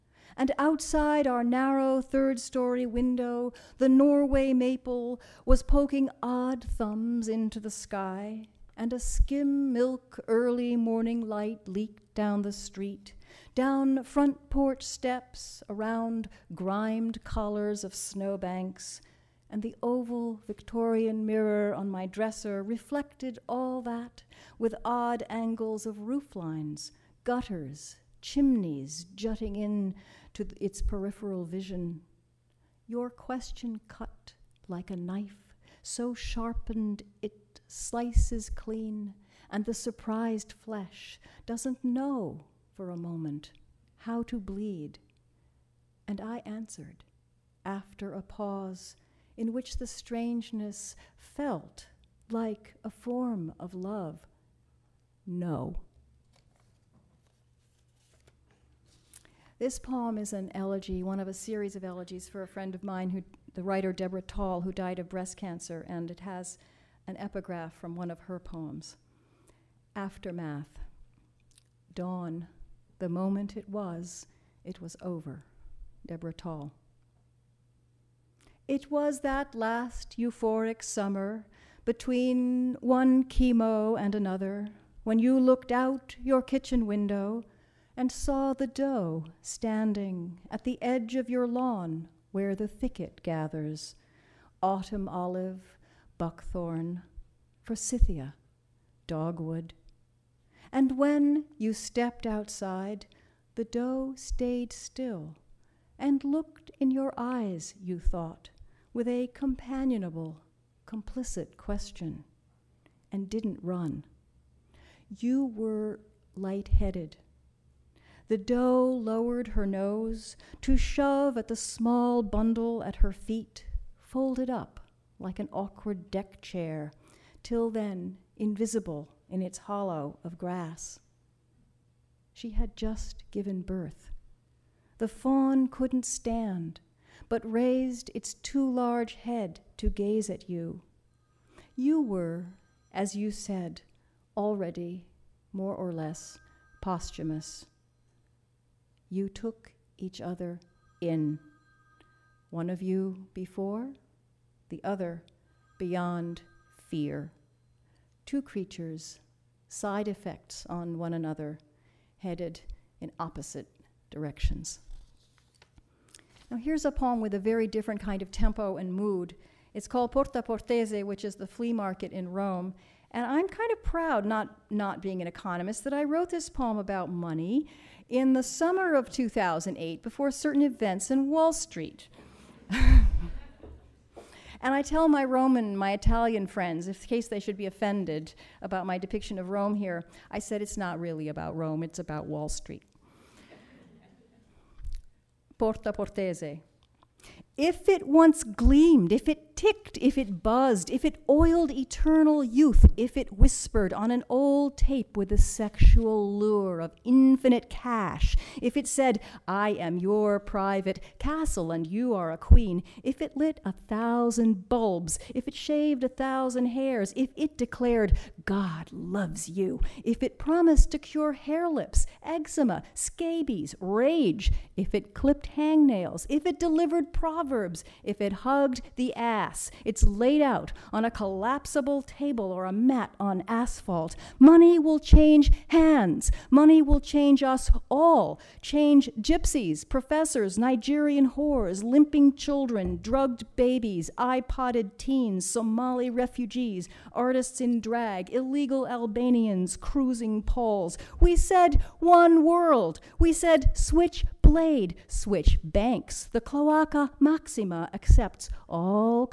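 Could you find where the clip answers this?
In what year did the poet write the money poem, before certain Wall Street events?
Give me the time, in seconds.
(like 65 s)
179 s.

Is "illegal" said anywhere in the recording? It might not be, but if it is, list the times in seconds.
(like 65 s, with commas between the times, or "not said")
248 s.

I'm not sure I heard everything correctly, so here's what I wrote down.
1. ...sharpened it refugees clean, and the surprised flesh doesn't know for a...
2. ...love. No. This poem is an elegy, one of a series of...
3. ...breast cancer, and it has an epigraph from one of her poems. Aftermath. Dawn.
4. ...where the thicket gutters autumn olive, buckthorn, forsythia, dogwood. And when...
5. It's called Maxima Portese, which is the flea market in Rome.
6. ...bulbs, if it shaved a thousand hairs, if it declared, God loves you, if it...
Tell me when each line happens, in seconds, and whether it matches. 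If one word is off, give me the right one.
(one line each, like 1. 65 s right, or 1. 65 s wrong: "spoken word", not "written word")
1. 36 s wrong: "slices", not "refugees"
2. 53 s right
3. 65 s right
4. 92 s wrong: "gathers", not "gutters"
5. 169 s wrong: "Porta", not "Maxima"
6. 214 s right.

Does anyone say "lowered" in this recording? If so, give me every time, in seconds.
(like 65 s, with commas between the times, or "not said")
118 s.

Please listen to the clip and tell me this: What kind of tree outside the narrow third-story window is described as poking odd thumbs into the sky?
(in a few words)
Norway maple.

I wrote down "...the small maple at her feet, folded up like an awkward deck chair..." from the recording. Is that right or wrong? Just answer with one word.
wrong.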